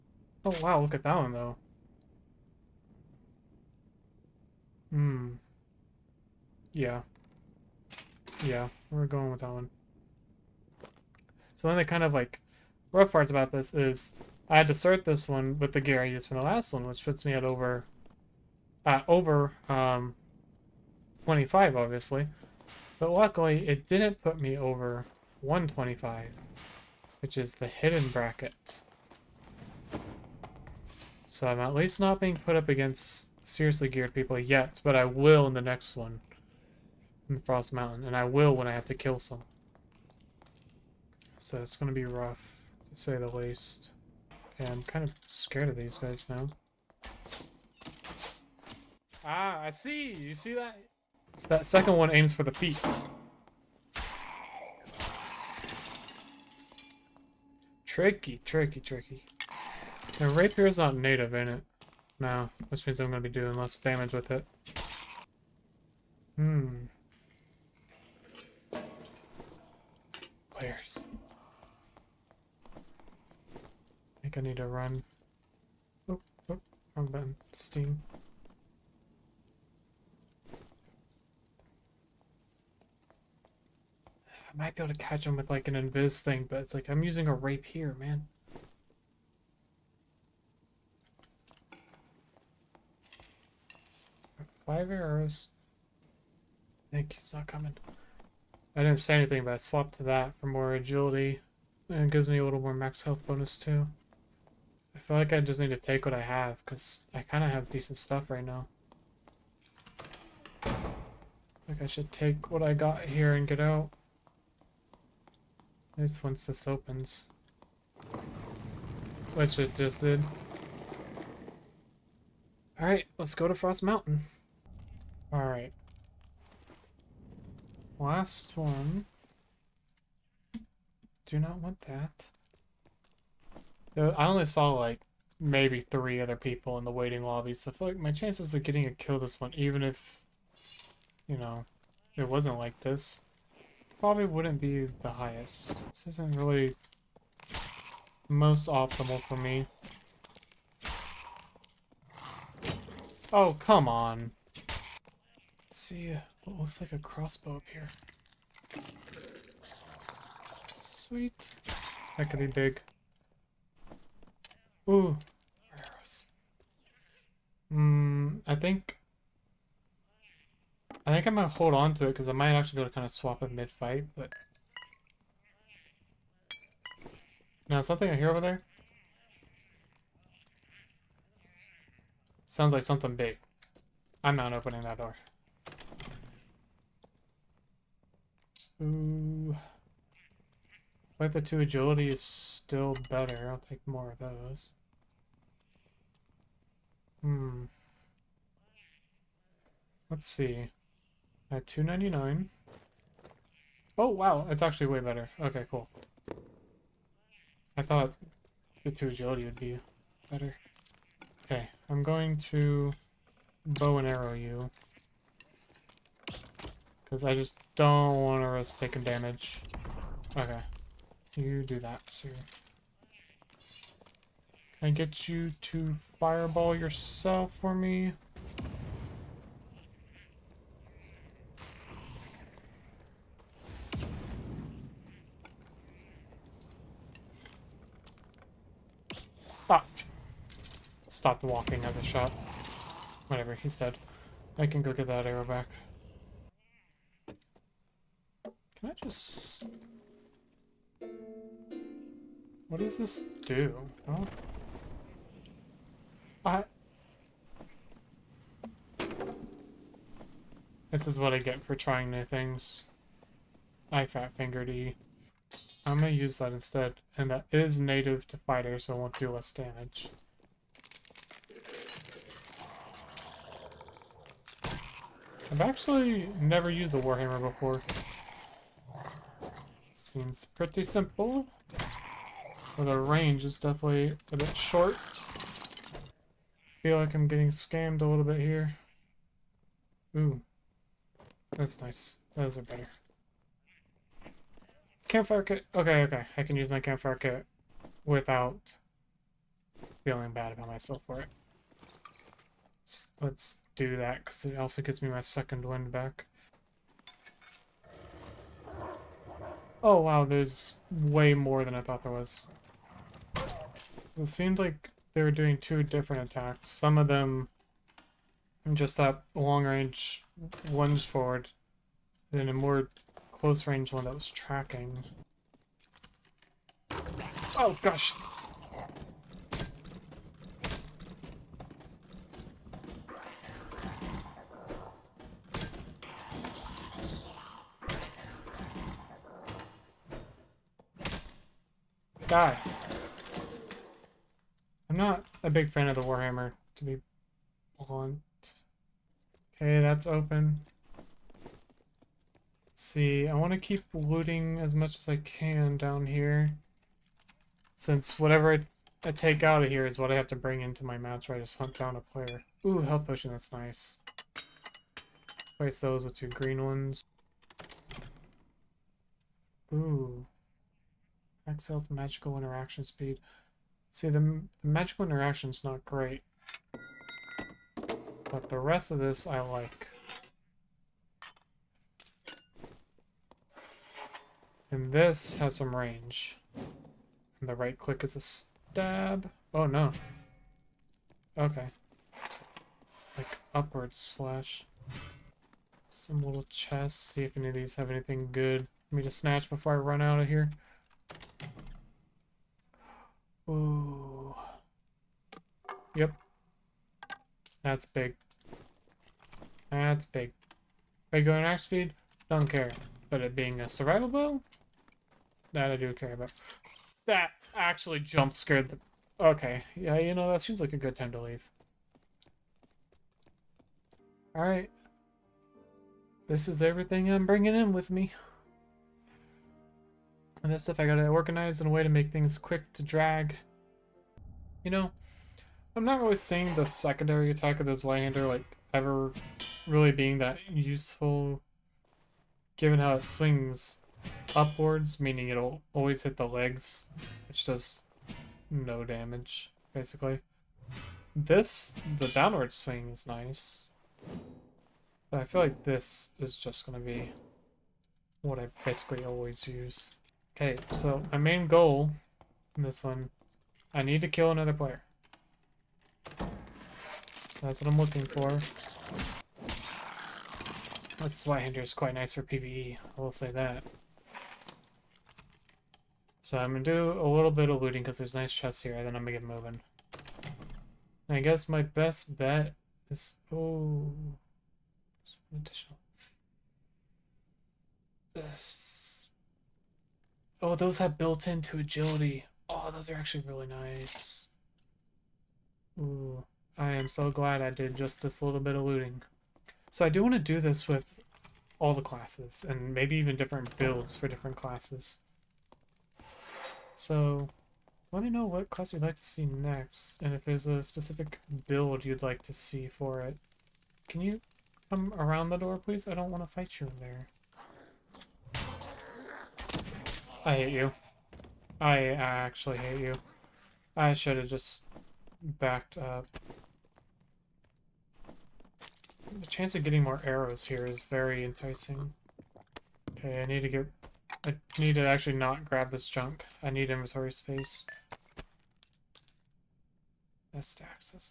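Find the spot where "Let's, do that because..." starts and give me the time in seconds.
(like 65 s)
303 s.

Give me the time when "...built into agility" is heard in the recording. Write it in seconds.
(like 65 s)
490 s.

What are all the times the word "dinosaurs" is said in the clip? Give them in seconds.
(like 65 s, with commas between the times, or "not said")
not said.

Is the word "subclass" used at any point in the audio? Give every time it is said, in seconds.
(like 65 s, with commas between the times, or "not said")
not said.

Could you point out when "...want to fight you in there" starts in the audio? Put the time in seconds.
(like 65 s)
516 s.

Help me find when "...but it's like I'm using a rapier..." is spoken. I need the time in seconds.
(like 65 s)
86 s.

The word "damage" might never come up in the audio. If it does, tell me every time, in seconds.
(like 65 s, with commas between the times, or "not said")
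63 s, 219 s, 269 s, 448 s.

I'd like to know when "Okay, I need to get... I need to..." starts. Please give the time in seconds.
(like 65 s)
532 s.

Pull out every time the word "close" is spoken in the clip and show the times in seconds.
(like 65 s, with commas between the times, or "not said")
323 s.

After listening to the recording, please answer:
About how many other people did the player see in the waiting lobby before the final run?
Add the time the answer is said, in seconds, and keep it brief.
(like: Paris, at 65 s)
3, at 135 s.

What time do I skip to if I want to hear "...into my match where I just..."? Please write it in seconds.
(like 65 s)
360 s.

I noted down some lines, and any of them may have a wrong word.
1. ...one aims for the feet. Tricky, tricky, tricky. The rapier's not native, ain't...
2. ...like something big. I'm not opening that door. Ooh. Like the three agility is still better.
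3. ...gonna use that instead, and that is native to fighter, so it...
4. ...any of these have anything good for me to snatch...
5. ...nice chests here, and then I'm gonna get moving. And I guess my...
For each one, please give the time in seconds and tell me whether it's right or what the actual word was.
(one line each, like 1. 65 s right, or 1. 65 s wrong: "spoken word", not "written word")
1. 51 s right
2. 182 s wrong: "two", not "three"
3. 265 s right
4. 397 s right
5. 478 s right.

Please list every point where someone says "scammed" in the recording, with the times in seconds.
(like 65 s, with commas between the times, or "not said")
287 s.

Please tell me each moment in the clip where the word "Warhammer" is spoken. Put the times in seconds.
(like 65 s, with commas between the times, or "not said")
277 s, 346 s.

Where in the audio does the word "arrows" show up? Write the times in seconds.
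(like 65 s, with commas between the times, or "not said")
94 s, 165 s, 214 s, 245 s, 530 s.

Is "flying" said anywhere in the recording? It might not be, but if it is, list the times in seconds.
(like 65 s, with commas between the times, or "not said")
not said.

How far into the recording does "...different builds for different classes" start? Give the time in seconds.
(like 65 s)
503 s.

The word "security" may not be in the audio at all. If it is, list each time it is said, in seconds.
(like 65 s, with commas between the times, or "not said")
not said.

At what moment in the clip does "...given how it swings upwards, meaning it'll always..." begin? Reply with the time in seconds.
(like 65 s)
442 s.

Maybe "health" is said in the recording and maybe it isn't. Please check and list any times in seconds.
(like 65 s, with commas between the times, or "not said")
103 s, 362 s, 371 s.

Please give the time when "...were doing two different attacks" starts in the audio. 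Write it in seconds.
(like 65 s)
315 s.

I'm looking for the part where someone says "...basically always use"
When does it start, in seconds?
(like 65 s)
458 s.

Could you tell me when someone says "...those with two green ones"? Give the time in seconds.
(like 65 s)
365 s.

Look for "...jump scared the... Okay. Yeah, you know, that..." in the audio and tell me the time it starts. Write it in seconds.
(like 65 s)
418 s.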